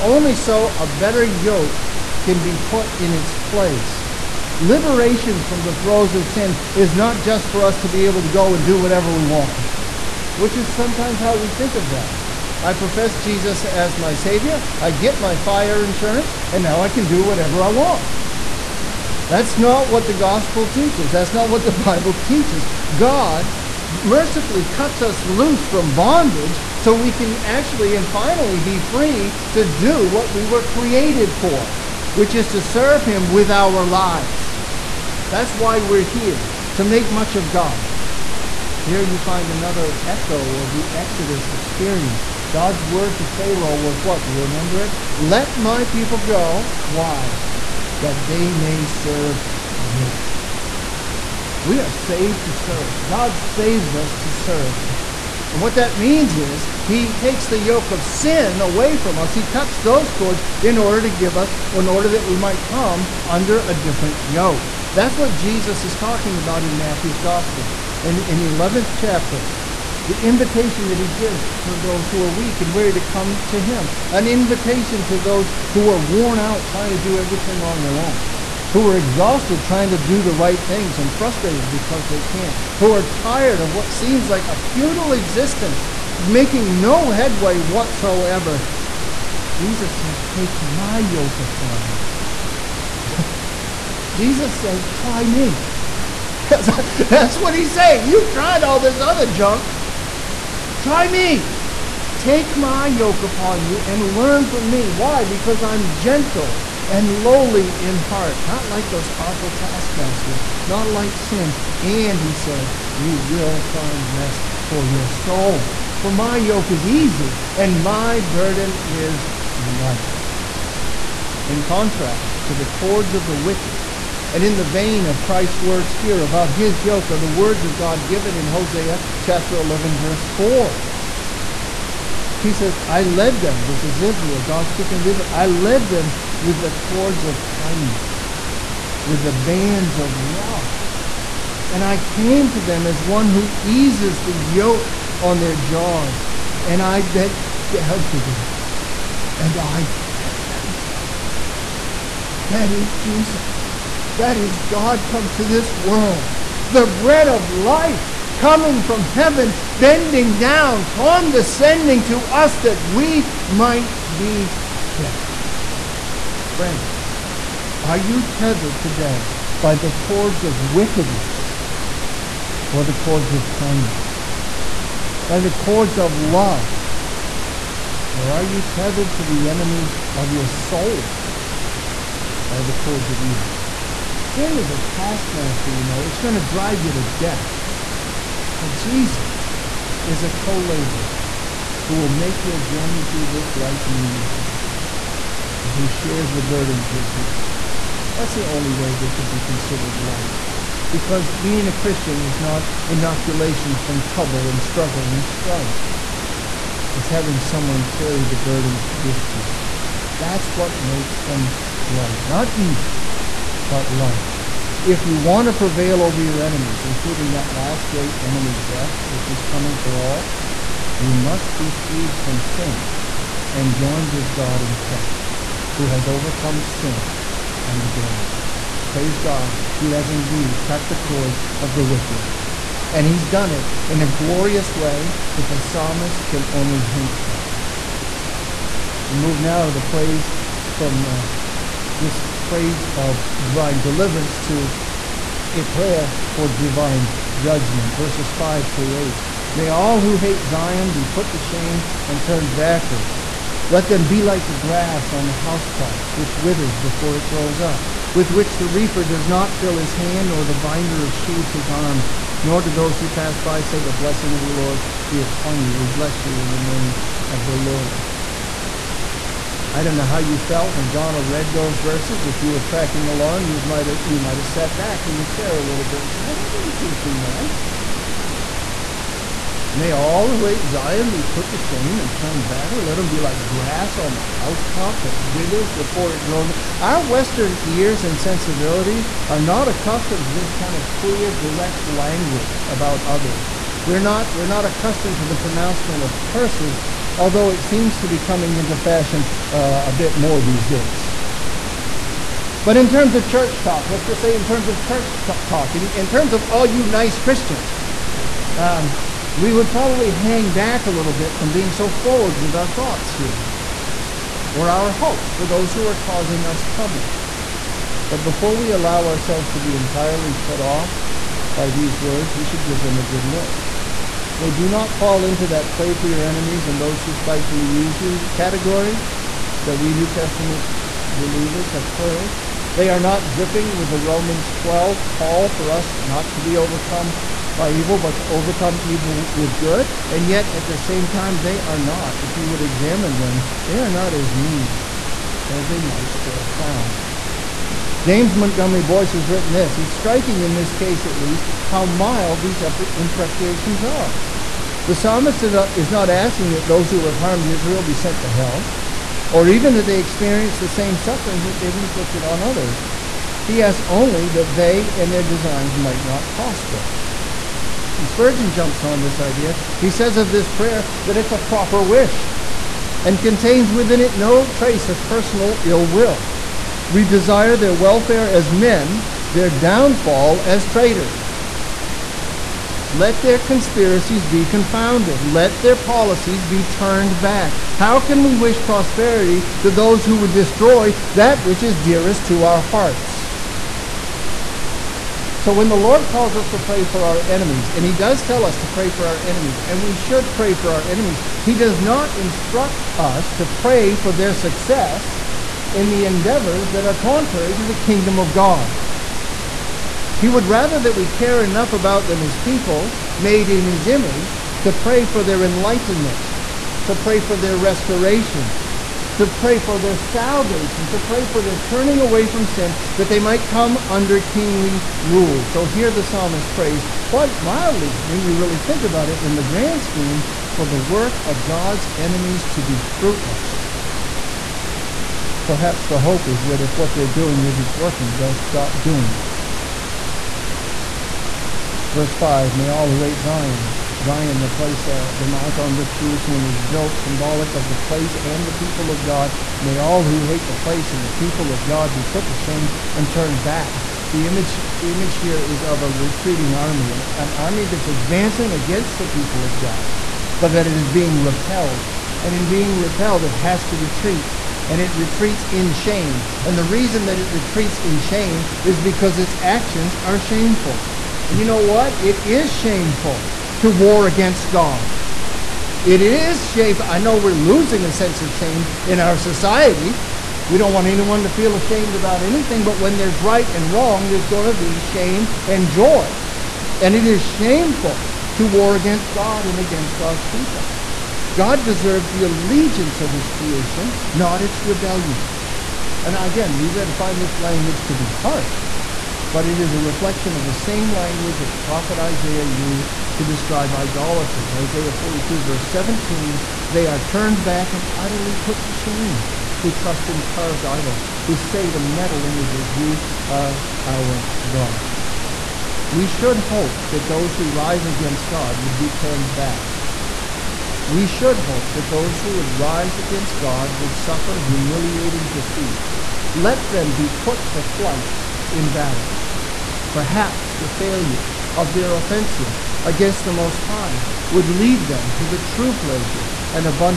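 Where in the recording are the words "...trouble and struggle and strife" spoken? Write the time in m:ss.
3:24.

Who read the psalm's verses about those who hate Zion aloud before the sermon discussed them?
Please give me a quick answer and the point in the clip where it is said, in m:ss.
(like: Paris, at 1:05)
Donna, at 4:30.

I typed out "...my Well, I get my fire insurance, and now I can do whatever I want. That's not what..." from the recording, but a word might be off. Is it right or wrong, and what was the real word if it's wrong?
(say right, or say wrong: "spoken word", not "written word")
wrong: "Savior", not "Well".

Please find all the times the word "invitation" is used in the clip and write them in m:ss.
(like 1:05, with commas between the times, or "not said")
1:10, 1:14.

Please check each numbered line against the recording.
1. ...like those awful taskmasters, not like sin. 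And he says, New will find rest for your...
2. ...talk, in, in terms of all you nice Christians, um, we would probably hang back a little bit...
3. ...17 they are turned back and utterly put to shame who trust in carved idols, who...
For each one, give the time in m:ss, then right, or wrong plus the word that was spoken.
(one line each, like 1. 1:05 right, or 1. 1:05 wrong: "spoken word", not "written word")
1. 1:48 wrong: "You", not "New"
2. 5:05 right
3. 8:25 right.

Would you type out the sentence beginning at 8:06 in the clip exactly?
And it is shameful to war against God and against God's people.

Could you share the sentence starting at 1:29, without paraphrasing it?
Jesus says, Take my yoke upon you.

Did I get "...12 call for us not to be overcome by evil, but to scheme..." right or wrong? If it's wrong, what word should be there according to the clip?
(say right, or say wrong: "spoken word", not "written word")
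wrong: "overcome", not "scheme".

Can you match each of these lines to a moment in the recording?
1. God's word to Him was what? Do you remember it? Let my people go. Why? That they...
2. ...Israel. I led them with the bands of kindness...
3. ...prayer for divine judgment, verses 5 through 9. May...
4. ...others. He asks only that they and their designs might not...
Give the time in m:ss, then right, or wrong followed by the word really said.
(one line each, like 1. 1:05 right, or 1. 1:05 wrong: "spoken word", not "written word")
1. 0:42 wrong: "Pharaoh", not "Him"
2. 2:15 wrong: "cords", not "bands"
3. 4:05 wrong: "8", not "9"
4. 6:02 right.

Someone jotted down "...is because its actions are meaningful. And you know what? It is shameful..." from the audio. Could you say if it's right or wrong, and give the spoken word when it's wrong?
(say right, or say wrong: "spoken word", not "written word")
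wrong: "shameful", not "meaningful".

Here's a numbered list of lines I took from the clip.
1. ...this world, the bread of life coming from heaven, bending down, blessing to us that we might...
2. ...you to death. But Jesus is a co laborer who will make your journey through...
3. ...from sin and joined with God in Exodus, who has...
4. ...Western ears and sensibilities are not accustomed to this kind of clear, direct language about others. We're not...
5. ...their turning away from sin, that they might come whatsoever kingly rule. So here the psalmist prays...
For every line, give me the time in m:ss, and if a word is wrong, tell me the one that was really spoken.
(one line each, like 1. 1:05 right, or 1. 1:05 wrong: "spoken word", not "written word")
1. 2:35 wrong: "condescending", not "blessing"
2. 3:06 right
3. 3:42 wrong: "Christ", not "Exodus"
4. 4:47 right
5. 7:01 wrong: "under", not "whatsoever".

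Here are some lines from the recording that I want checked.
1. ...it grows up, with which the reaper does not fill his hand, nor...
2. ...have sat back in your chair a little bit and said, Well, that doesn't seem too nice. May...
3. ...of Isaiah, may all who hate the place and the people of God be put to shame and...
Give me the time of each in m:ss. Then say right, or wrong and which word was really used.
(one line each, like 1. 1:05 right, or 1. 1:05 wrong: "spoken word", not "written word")
1. 4:17 right
2. 4:34 right
3. 7:28 wrong: "God", not "Isaiah".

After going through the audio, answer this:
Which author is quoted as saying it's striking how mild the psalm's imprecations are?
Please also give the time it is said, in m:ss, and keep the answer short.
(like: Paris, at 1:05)
James Montgomery Boice, at 5:48.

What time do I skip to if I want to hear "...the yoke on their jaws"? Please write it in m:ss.
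2:24.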